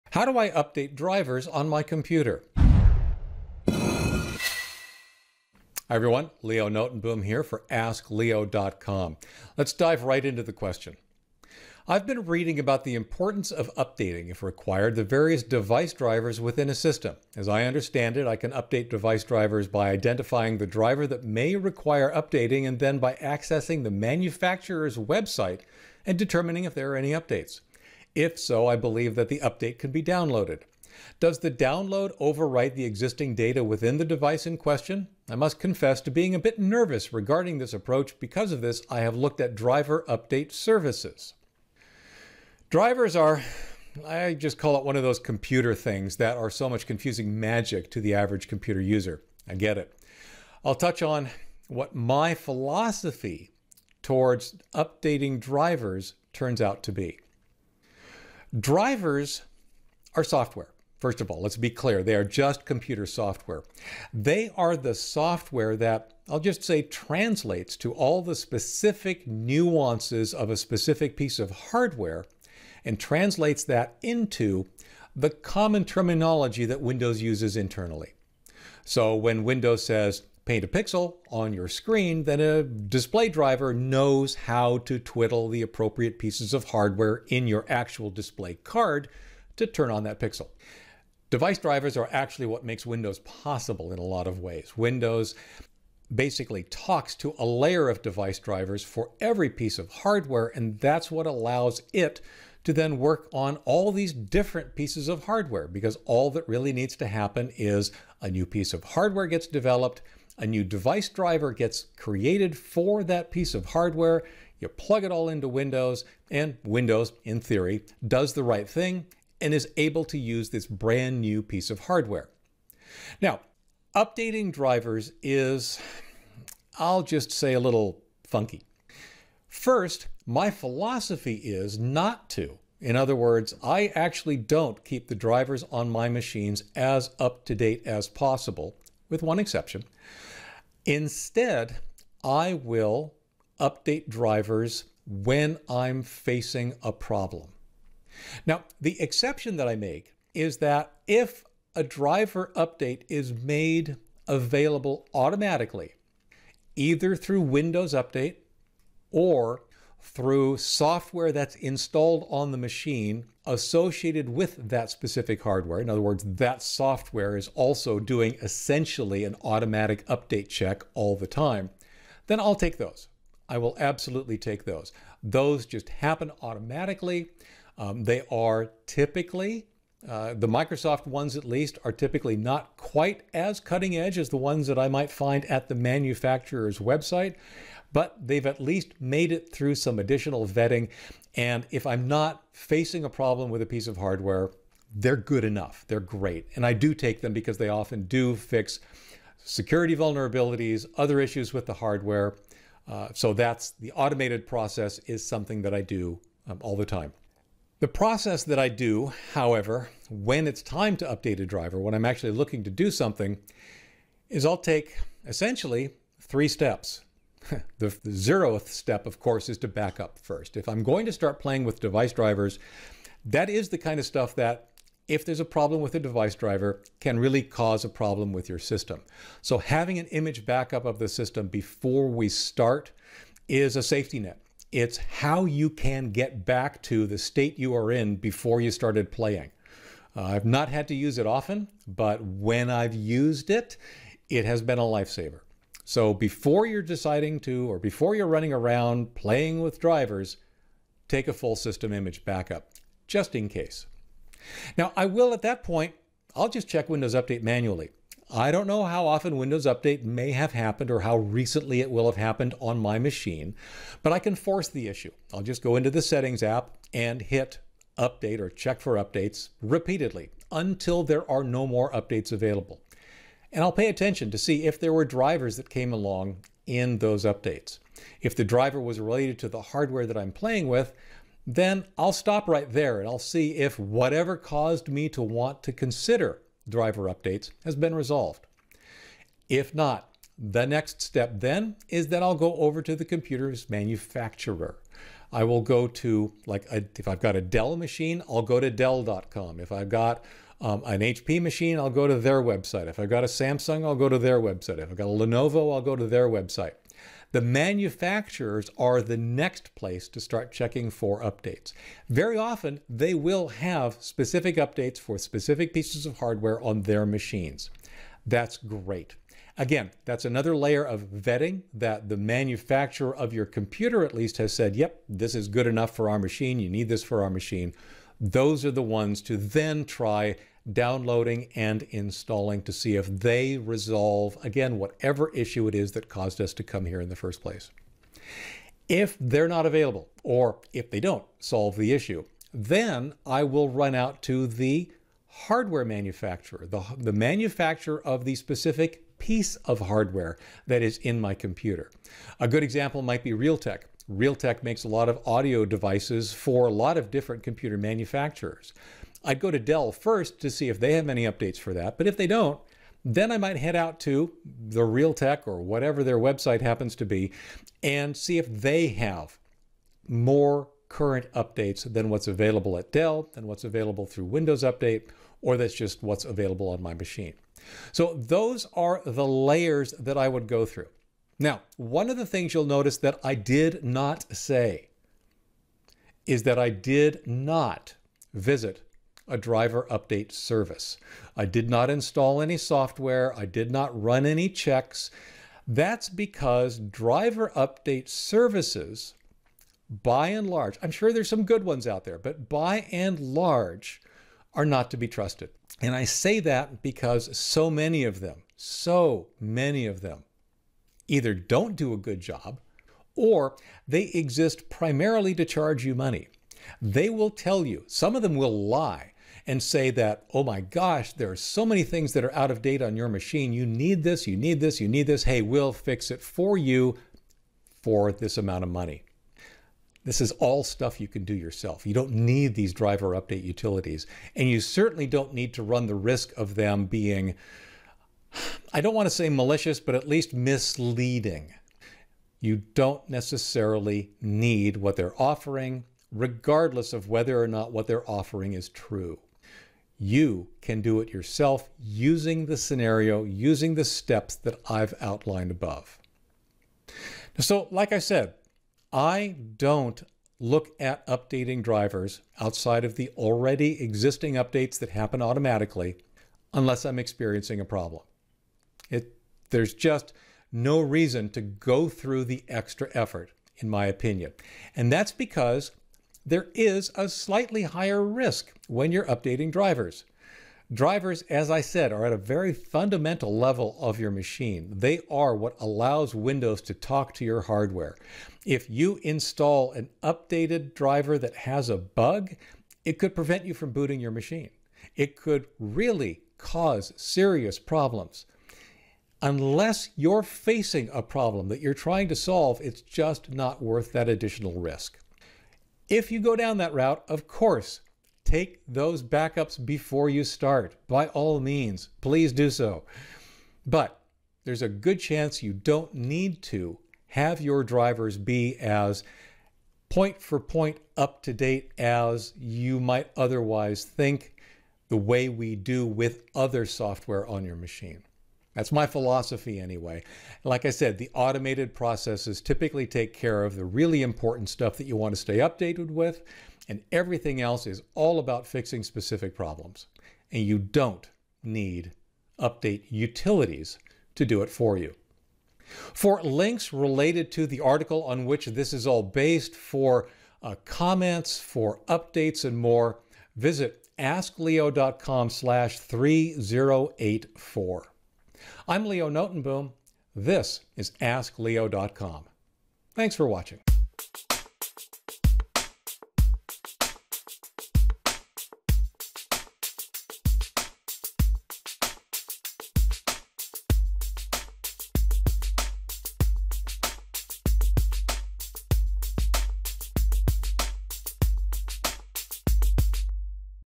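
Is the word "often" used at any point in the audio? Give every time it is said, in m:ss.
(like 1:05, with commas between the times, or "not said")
3:17, 4:01, 4:19, 5:12.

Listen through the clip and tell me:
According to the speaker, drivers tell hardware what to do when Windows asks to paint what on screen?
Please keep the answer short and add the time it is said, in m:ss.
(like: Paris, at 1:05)
A pixel, at 1:20.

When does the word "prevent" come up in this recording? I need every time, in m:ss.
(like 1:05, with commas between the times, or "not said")
8:13.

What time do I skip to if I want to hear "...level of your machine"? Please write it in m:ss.
8:03.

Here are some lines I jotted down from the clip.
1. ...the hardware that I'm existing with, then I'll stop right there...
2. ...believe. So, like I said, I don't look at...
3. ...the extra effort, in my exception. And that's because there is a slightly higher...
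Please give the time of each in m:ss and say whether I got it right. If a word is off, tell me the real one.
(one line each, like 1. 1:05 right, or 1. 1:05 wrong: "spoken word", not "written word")
1. 4:39 wrong: "playing", not "existing"
2. 7:35 wrong: "above", not "believe"
3. 7:52 wrong: "opinion", not "exception".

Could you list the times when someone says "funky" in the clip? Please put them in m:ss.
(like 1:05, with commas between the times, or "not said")
2:08.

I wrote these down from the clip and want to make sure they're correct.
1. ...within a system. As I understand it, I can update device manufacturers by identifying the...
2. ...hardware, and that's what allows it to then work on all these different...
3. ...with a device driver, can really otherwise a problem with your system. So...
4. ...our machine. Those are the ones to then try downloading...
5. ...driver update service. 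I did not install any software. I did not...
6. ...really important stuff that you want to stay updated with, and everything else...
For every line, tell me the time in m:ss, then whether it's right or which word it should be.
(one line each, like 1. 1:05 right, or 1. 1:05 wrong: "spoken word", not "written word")
1. 0:16 wrong: "drivers", not "manufacturers"
2. 1:39 right
3. 3:45 wrong: "cause", not "otherwise"
4. 5:27 right
5. 6:29 right
6. 8:53 right.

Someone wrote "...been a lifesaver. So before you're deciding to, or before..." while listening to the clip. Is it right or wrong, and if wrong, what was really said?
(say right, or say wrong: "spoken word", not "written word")
right.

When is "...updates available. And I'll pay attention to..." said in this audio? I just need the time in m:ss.
4:31.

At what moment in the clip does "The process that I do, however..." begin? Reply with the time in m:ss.
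3:27.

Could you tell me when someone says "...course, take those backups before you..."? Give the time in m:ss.
8:27.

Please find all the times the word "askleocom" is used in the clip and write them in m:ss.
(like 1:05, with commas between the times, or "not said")
0:07, 9:13, 9:21.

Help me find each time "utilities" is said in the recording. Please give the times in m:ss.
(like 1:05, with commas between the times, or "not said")
7:13, 9:02.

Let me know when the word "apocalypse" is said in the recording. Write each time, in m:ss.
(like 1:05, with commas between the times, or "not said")
not said.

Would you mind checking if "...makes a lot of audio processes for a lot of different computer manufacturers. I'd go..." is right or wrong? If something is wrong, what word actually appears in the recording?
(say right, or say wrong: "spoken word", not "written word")
wrong: "devices", not "processes".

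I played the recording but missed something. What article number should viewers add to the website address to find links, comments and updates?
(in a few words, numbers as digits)
3084.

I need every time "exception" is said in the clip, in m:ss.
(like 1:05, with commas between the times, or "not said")
2:19, 2:28.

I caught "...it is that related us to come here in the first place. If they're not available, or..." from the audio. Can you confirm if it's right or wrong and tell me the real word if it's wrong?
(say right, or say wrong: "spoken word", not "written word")
wrong: "caused", not "related".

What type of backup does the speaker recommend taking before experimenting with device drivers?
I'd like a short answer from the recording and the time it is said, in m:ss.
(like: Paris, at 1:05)
Full system image backup, at 4:11.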